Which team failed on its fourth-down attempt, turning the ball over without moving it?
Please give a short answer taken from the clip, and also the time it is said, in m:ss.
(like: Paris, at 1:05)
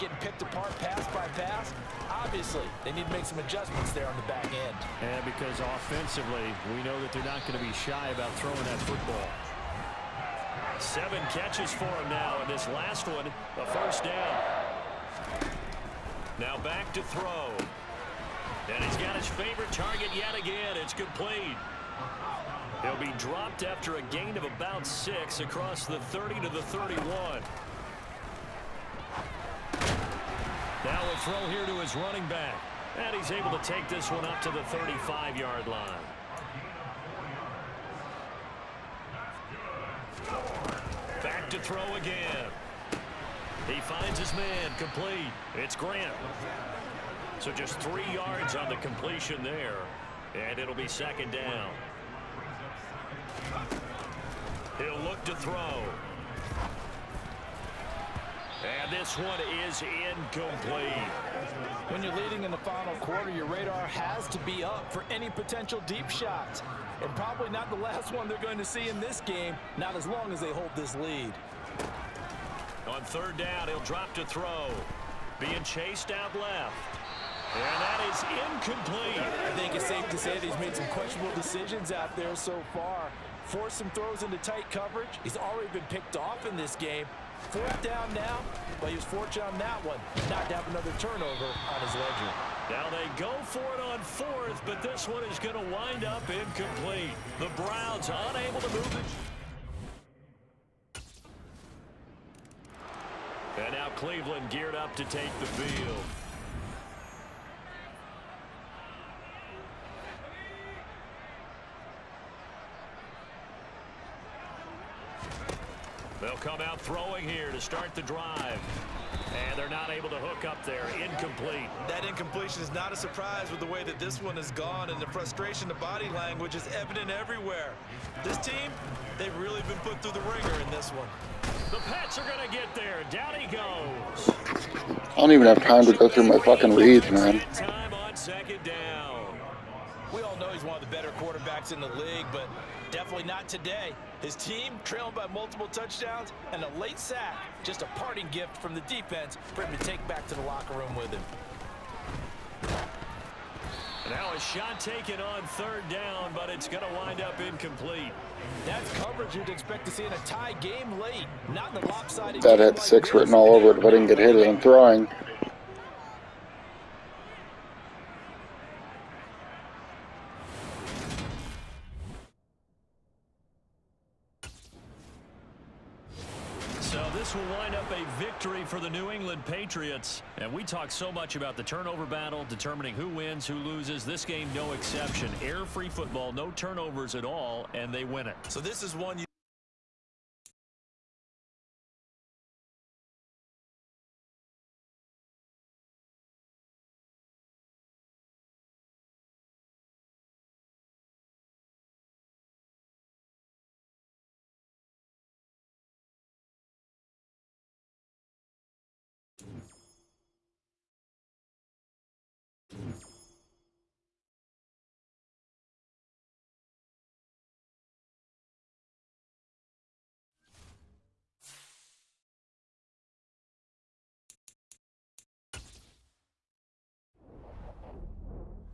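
Browns, at 1:37.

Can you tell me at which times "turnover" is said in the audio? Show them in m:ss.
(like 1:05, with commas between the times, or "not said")
1:30, 3:01, 3:06.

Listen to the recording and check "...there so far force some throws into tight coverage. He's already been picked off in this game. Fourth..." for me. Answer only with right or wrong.
right.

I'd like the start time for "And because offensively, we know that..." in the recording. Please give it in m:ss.
0:05.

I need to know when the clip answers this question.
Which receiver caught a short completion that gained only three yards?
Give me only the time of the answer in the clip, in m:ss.
0:45.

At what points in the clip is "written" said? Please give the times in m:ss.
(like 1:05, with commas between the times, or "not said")
2:43.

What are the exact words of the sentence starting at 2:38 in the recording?
That's coverage you'd expect to see in a tie game late.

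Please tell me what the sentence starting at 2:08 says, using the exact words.
This team, they've really been put through the ringer in this one.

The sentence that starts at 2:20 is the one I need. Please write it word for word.
We all know he's one of the better quarterbacks in the league, but Definitely not today.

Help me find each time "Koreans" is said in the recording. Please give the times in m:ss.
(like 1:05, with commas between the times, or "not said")
not said.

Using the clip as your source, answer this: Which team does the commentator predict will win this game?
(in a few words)
New England Patriots.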